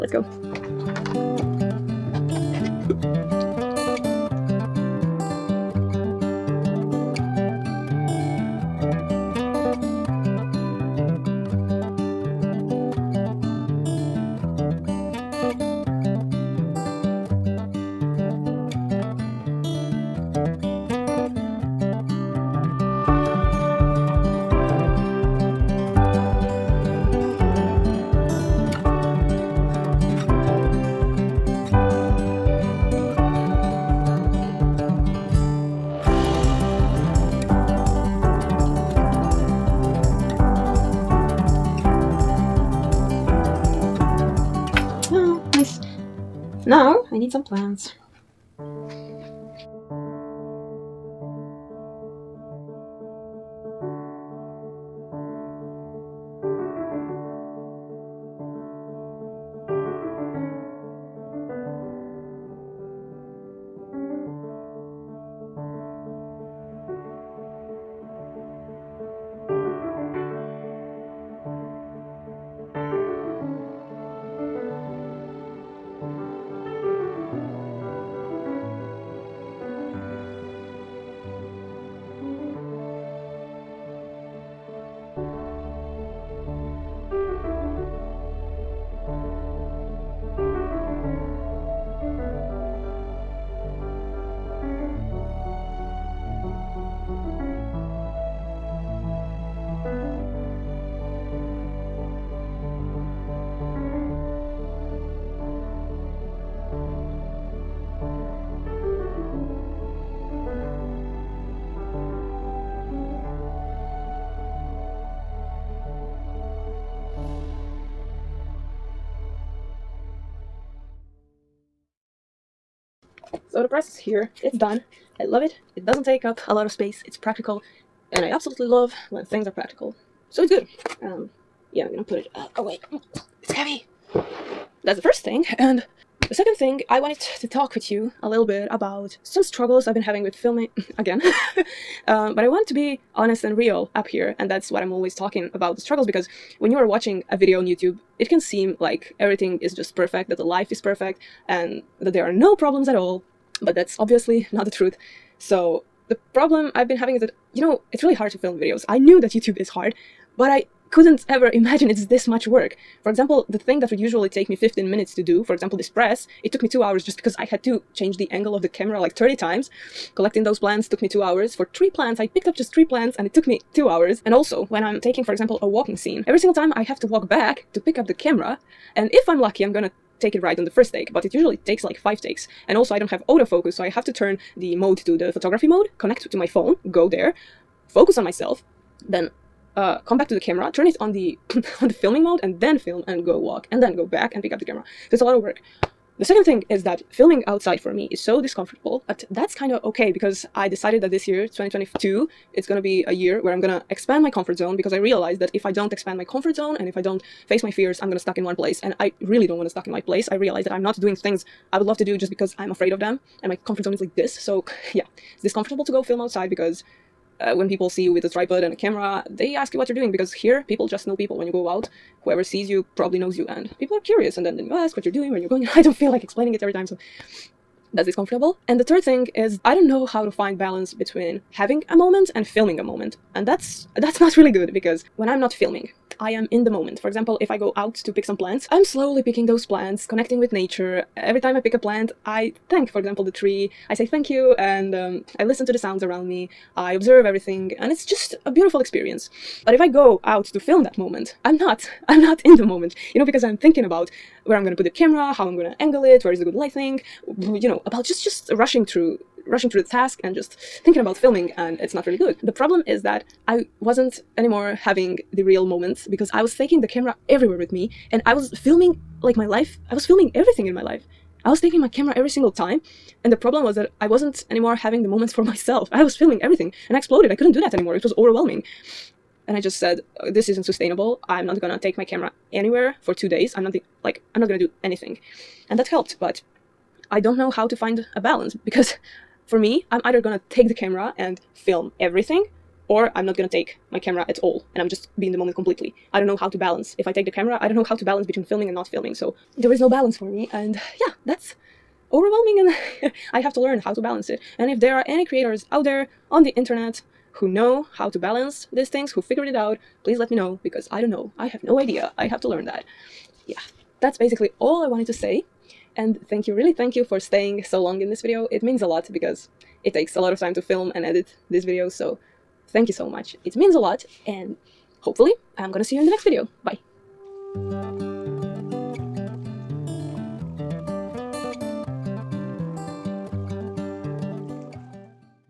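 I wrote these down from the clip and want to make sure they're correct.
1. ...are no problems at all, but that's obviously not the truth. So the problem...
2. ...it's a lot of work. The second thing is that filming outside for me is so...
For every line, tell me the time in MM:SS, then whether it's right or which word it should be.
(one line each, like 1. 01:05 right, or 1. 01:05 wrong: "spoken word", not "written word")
1. 02:32 right
2. 03:15 right.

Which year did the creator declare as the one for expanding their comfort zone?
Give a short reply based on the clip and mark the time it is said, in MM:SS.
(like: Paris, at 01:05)
2022, at 03:21.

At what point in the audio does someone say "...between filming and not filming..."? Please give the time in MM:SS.
04:58.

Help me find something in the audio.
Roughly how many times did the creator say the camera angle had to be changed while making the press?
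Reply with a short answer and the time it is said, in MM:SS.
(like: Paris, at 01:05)
30, at 02:48.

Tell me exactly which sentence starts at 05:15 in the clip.
And thank you, really thank you for staying so long in this video.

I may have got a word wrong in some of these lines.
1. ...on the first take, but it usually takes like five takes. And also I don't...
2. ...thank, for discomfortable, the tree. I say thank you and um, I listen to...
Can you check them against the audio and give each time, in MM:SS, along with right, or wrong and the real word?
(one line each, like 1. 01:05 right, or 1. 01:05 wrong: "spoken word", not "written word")
1. 03:00 right
2. 04:02 wrong: "example", not "discomfortable".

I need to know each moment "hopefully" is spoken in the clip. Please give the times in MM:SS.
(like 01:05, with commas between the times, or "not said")
05:25.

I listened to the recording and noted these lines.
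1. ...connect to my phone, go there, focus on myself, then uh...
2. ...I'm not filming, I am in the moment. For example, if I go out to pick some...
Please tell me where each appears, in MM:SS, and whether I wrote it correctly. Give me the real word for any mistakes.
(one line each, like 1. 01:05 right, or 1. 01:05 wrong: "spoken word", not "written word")
1. 03:05 right
2. 03:55 right.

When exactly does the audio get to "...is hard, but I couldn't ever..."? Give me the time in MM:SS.
02:39.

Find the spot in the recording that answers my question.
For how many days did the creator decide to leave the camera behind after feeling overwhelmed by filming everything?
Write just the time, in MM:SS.
04:43.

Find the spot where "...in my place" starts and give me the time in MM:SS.
03:29.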